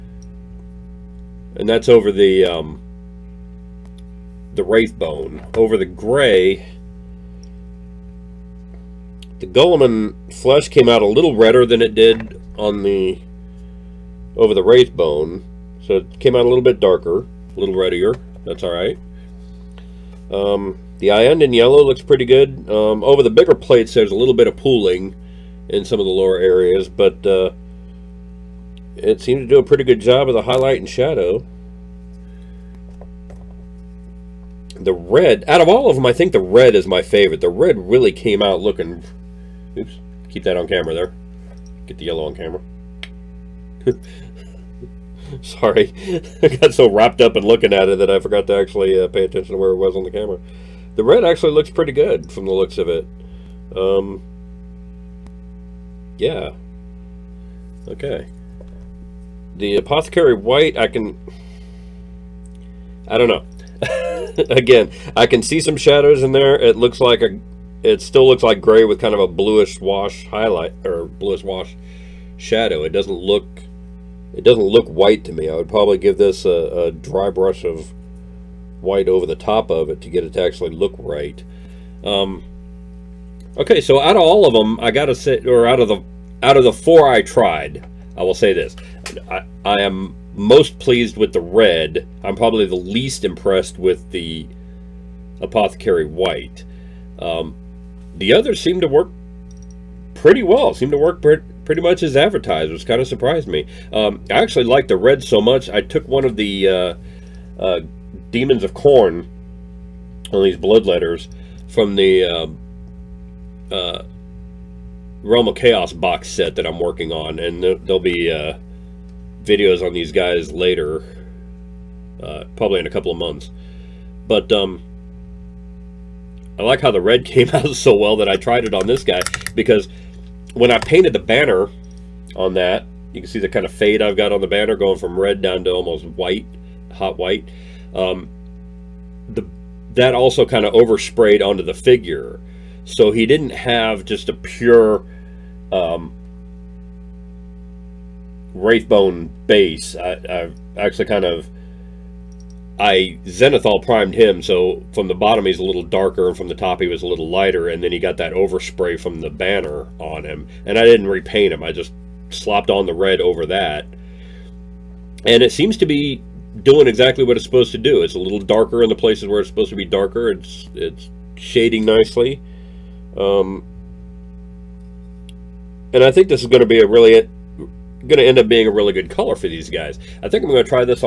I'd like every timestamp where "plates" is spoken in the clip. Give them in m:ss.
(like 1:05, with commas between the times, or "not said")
0:23.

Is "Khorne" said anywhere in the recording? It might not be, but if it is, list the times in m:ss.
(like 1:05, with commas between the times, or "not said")
1:48.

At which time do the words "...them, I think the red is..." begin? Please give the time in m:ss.
0:35.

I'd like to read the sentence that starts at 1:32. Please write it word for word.
I'm probably the least impressed with the Apothecary White.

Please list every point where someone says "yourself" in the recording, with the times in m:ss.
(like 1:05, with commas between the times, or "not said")
not said.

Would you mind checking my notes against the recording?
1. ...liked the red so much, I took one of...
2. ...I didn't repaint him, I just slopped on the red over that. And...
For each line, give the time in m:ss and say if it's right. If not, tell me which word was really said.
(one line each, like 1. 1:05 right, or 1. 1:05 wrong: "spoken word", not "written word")
1. 1:44 right
2. 2:40 right.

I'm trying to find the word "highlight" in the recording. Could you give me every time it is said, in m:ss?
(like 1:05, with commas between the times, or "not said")
0:30, 1:10.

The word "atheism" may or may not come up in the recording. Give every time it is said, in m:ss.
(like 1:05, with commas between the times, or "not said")
not said.